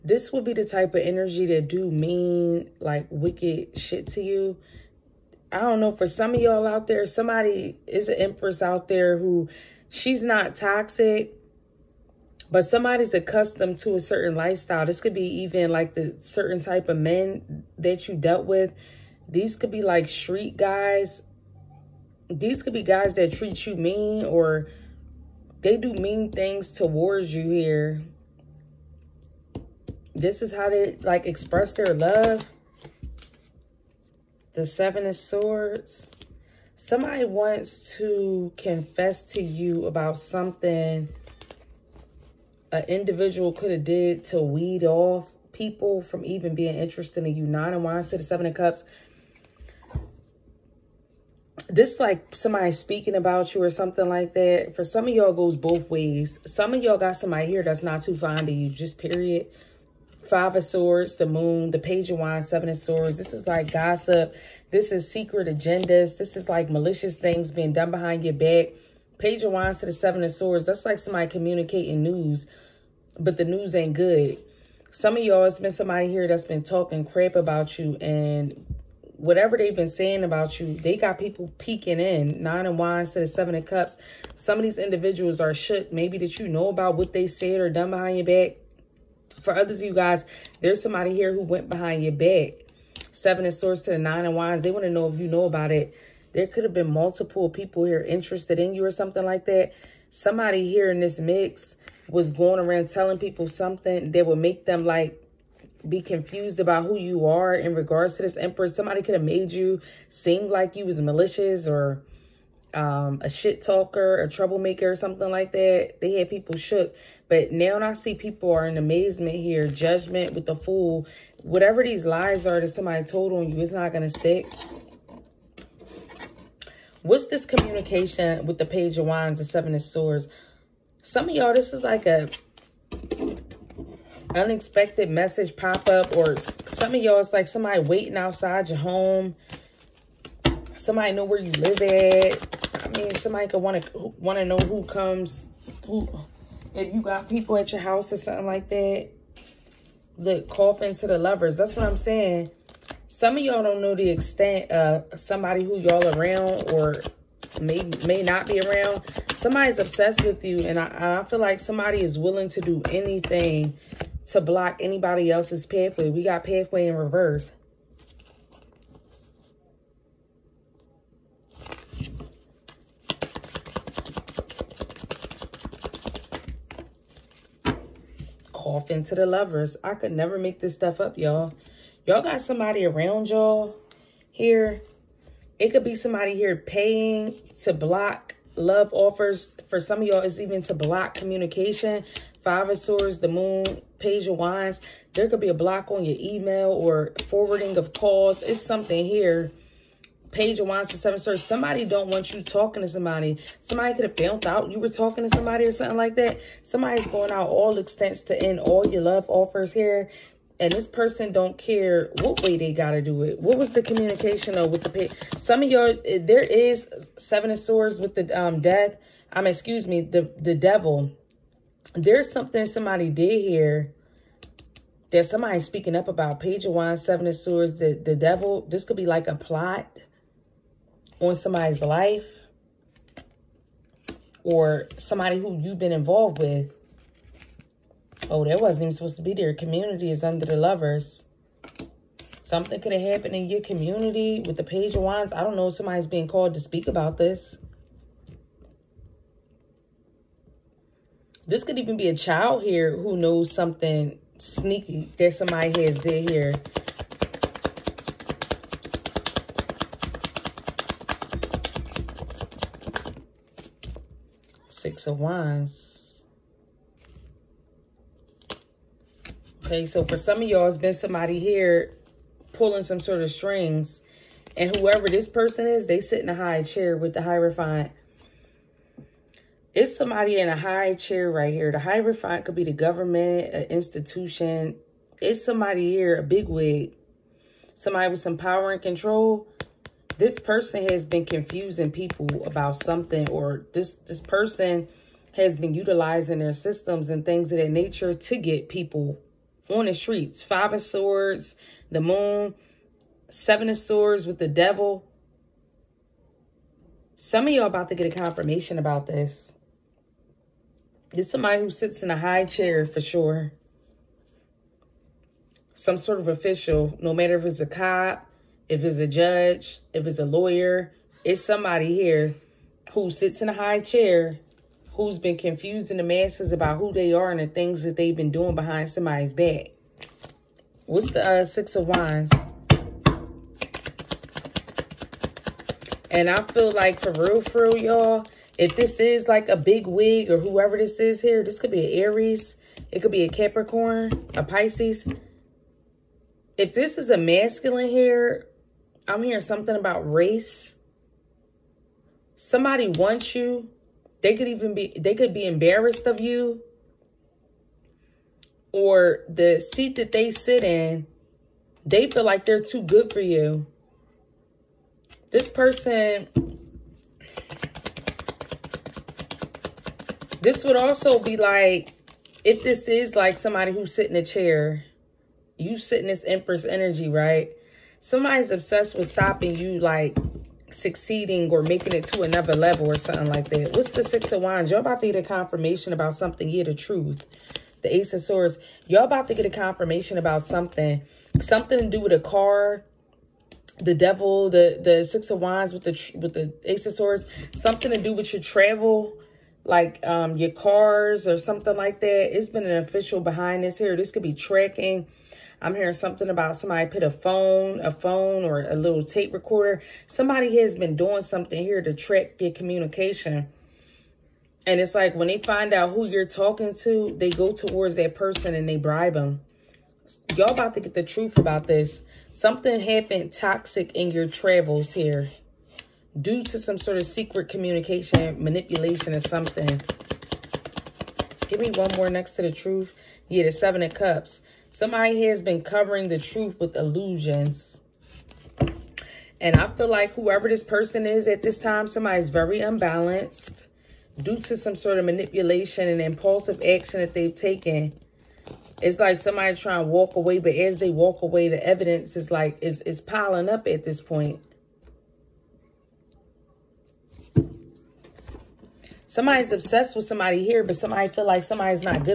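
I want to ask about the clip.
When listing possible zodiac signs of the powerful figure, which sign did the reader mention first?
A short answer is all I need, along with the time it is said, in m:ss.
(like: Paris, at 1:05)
Aries, at 5:42.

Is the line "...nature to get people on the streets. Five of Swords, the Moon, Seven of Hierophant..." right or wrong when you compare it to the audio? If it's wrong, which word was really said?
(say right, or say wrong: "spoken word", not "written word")
wrong: "Swords", not "Hierophant".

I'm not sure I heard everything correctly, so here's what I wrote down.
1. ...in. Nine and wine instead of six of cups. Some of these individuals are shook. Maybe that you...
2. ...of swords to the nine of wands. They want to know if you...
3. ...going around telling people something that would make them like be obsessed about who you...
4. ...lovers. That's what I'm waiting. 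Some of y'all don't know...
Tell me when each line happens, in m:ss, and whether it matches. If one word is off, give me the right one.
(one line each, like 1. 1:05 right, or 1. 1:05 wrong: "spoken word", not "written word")
1. 1:22 wrong: "seven", not "six"
2. 1:33 right
3. 1:42 wrong: "confused", not "obsessed"
4. 2:31 wrong: "saying", not "waiting".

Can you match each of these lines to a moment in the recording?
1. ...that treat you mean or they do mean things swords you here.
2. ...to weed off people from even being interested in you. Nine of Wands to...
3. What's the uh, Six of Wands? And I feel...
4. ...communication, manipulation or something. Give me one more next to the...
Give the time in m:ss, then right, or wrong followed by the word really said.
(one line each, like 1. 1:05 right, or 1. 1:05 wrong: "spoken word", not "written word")
1. 0:23 wrong: "towards", not "swords"
2. 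0:44 right
3. 5:30 right
4. 7:07 right.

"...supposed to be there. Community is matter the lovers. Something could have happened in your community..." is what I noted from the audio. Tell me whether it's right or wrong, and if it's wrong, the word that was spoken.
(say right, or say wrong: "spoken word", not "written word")
wrong: "under", not "matter".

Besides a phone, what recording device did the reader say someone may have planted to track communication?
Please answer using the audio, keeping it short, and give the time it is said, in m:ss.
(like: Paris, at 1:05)
tape recorder, at 6:49.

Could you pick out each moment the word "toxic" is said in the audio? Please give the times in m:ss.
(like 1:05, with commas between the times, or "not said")
0:10, 7:03.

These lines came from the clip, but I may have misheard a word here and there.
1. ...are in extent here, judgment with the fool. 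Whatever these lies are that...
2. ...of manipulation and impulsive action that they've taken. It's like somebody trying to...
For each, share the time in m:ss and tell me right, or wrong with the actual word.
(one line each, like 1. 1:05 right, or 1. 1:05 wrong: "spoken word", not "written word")
1. 1:58 wrong: "amazement", not "extent"
2. 7:24 right.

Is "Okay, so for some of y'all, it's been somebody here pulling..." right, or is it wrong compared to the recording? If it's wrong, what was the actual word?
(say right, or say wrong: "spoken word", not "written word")
right.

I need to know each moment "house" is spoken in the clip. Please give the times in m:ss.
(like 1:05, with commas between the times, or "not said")
2:27.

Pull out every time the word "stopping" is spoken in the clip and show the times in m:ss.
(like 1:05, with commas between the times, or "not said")
6:19.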